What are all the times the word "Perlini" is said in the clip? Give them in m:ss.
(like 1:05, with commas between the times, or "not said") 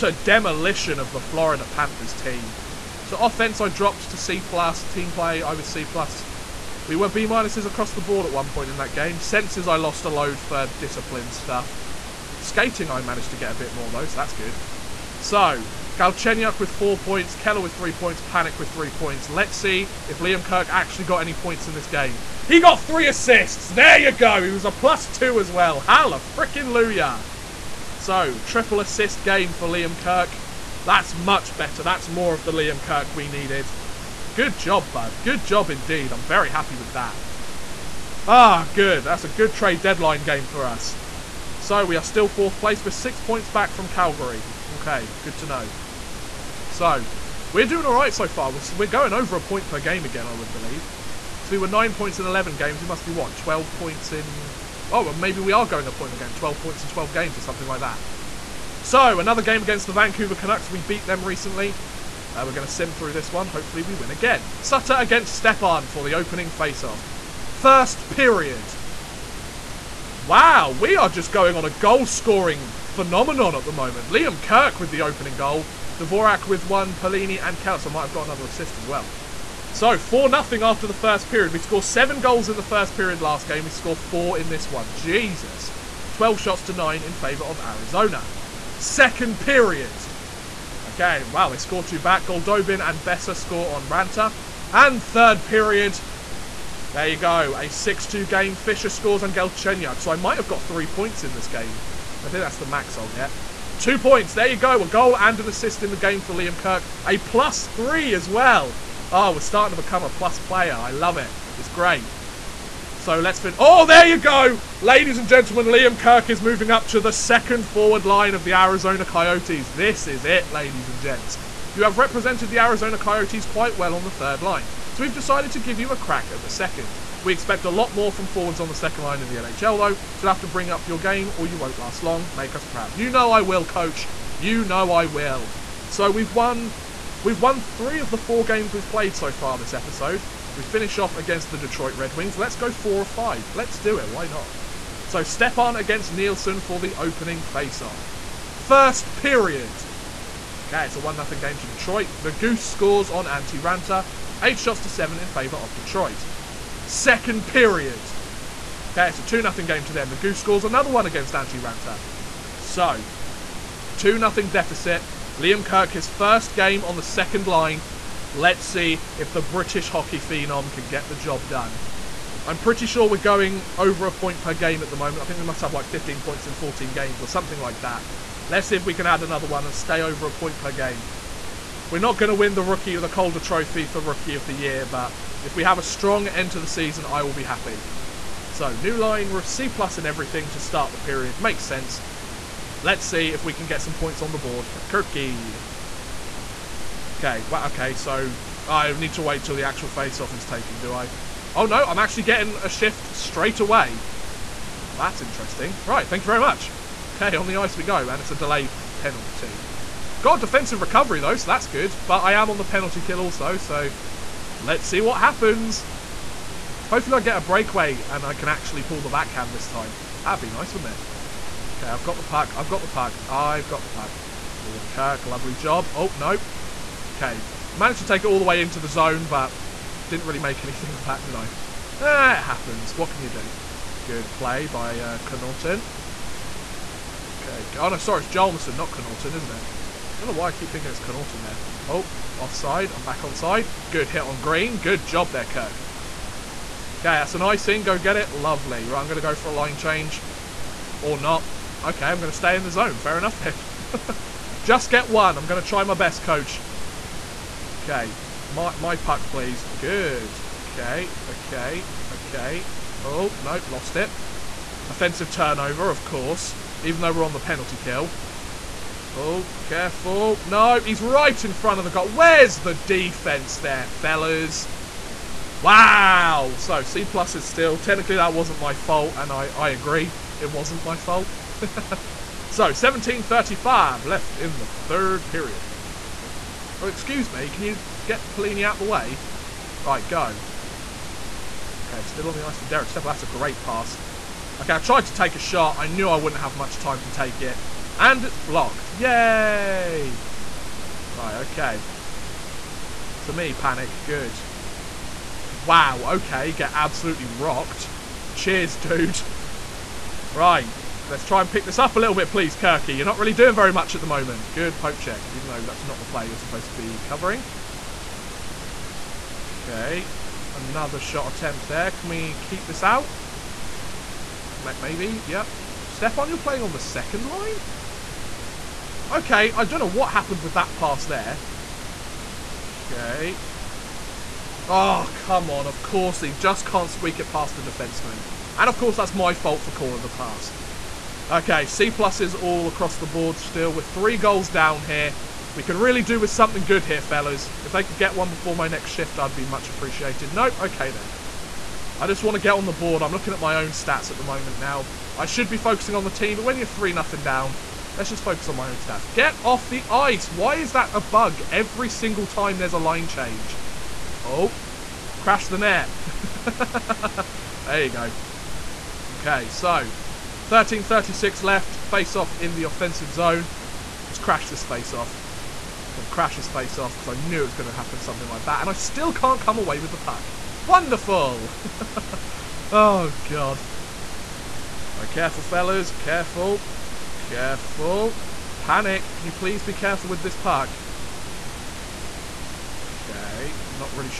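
1:16, 4:48.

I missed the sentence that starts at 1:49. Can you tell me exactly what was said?
Oh, we're starting to become a plus player.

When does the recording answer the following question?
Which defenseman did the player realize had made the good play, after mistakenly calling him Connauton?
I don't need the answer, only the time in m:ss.
3:58.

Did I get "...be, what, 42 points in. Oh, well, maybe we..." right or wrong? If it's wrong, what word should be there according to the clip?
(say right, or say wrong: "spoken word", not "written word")
wrong: "12", not "42".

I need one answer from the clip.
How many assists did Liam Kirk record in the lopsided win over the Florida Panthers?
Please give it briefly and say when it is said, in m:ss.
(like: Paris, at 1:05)
3, at 0:22.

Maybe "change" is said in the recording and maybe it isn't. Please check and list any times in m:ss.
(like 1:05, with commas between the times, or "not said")
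4:09, 6:03.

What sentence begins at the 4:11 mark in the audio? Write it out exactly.
Okay, I'm going to stay in the zone.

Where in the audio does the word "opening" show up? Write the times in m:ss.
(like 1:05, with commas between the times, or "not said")
1:06, 1:15, 2:26.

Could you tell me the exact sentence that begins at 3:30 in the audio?
Got defensive recovery, though, so that's good.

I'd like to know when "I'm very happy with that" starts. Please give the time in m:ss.
0:36.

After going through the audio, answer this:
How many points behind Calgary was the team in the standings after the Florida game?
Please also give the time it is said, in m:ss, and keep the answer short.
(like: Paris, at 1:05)
6, at 0:42.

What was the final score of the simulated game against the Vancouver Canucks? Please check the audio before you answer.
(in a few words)
6-2.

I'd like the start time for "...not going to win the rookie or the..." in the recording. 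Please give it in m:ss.
3:01.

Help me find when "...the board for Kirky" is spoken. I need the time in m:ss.
3:14.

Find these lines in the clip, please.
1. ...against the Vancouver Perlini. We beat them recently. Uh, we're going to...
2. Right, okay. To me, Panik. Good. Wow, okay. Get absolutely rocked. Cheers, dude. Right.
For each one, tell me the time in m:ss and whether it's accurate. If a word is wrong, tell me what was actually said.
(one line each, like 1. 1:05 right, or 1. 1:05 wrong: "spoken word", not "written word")
1. 0:59 wrong: "Canucks", not "Perlini"
2. 5:01 right.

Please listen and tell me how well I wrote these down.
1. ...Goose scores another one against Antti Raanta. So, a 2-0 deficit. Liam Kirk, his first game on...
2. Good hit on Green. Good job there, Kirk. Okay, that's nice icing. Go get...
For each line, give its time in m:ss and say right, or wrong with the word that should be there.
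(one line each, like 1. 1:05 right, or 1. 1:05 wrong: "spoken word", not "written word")
1. 2:40 right
2. 4:03 right.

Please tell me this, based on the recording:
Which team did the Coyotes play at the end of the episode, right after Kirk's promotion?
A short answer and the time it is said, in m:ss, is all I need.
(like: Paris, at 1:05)
Detroit Red Wings, at 2:21.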